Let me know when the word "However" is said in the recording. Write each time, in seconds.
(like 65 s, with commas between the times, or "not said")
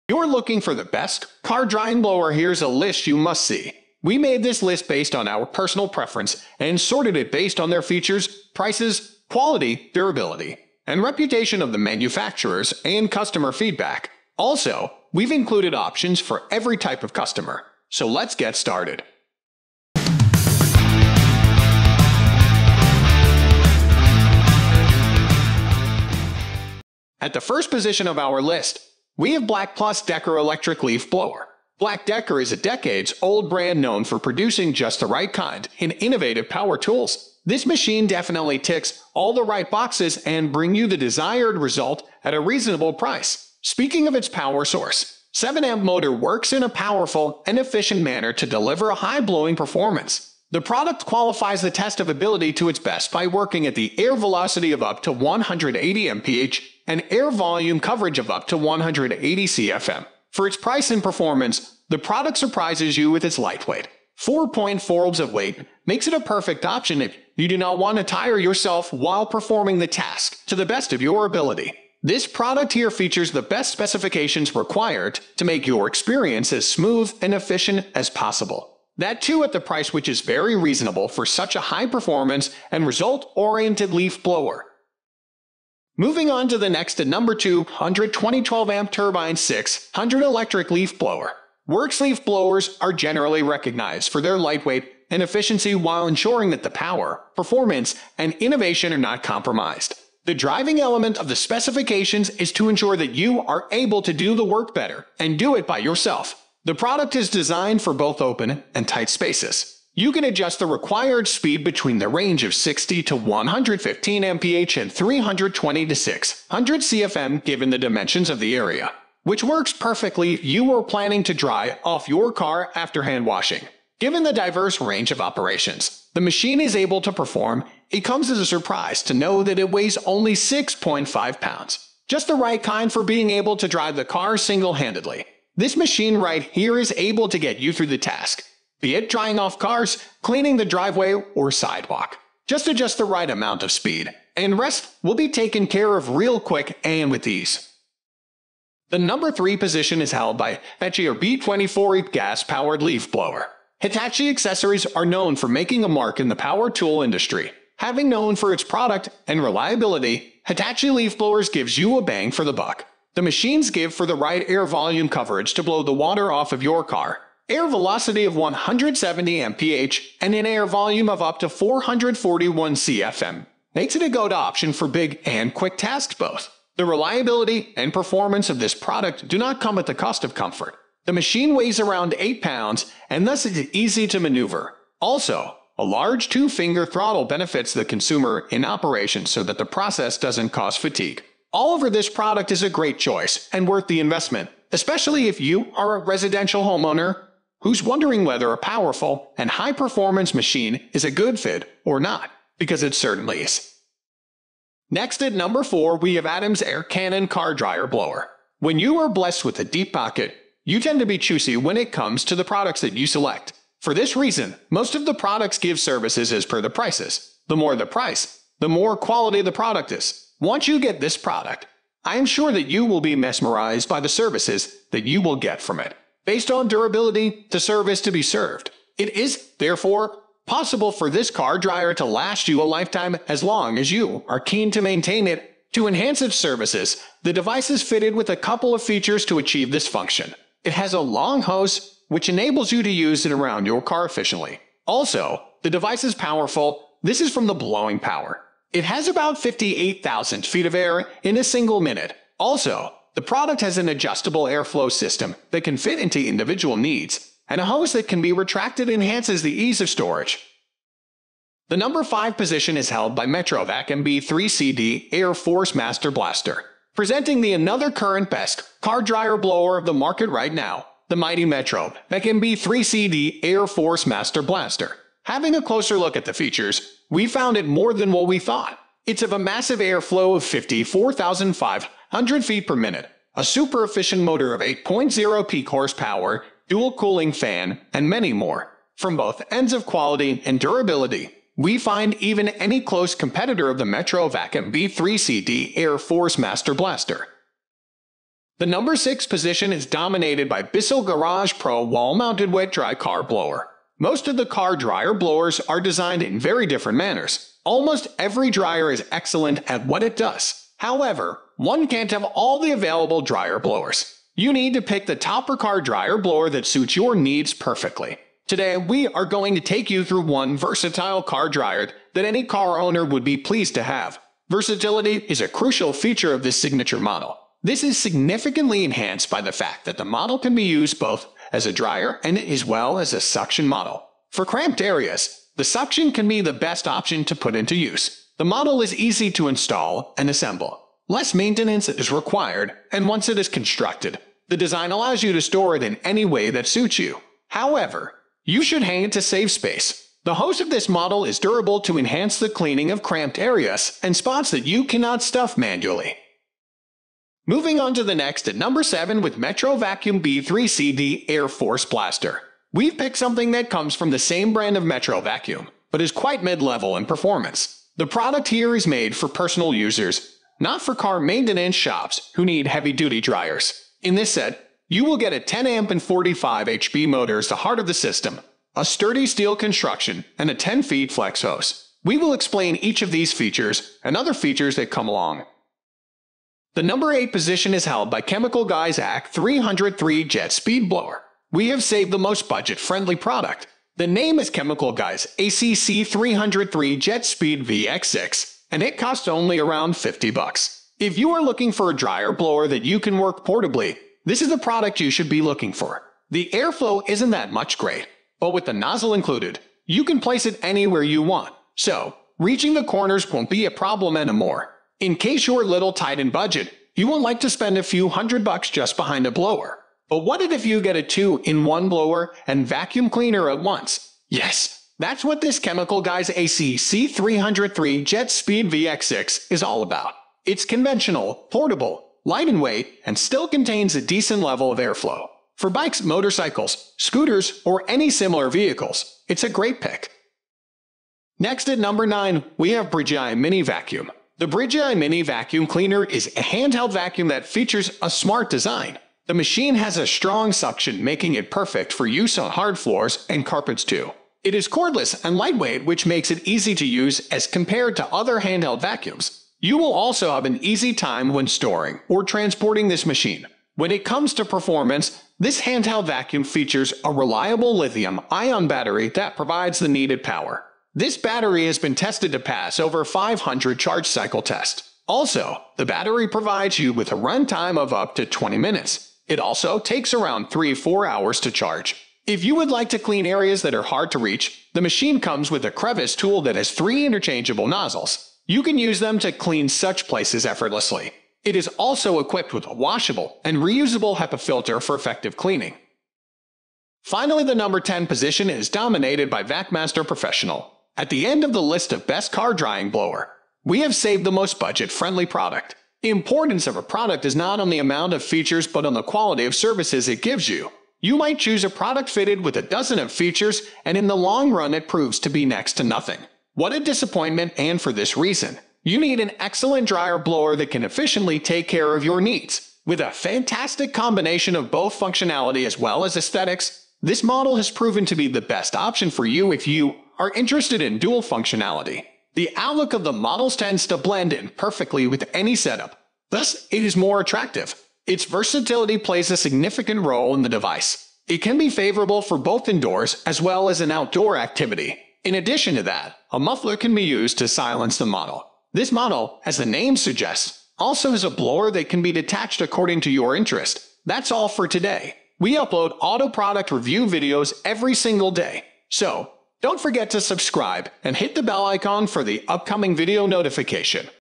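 310 s, 347 s.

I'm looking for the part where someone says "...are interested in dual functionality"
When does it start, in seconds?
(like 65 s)
530 s.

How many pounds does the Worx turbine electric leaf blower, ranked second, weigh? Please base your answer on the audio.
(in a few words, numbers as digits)
6.5 pounds.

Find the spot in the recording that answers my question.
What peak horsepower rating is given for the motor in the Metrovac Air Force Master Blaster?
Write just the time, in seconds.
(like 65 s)
284 s.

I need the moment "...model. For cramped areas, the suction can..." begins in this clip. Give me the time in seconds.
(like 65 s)
333 s.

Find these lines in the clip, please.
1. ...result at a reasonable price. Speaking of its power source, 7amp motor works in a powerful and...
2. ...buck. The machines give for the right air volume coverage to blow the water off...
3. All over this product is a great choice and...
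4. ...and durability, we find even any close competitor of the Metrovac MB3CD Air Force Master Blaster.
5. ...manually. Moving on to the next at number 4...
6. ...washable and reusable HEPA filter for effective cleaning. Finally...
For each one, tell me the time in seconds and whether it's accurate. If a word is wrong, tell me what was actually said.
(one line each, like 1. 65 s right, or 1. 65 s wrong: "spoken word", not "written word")
1. 41 s right
2. 162 s right
3. 191 s right
4. 290 s right
5. 355 s wrong: "7", not "4"
6. 492 s right.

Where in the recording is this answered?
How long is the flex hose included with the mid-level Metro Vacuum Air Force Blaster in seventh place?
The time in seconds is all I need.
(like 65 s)
380 s.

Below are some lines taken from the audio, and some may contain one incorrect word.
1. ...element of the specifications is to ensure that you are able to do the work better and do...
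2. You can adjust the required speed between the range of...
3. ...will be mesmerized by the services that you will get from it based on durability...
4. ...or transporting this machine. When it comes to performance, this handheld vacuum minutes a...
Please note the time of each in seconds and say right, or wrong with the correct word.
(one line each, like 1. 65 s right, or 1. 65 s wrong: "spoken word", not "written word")
1. 100 s right
2. 109 s right
3. 222 s right
4. 462 s wrong: "features", not "minutes".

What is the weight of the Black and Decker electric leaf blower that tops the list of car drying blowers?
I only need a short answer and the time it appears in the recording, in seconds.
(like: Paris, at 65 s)
4.4 lbs, at 64 s.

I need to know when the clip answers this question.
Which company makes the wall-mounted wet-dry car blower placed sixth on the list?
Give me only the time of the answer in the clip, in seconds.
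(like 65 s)
300 s.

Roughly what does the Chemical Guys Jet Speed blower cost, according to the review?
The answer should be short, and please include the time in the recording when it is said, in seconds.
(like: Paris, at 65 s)
$50, at 399 s.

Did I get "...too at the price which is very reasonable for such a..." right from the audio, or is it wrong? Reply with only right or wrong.
right.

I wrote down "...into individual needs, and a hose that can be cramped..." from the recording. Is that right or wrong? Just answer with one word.
wrong.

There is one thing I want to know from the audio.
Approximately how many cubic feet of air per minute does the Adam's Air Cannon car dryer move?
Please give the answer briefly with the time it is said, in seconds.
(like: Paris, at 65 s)
58,000, at 249 s.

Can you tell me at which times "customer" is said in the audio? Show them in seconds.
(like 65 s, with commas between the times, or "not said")
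13 s, 17 s.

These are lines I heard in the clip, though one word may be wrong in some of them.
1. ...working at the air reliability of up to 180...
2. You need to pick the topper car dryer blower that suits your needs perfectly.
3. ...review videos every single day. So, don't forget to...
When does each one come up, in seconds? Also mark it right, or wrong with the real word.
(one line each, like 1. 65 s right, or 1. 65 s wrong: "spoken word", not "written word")
1. 53 s wrong: "velocity", not "reliability"
2. 314 s right
3. 556 s right.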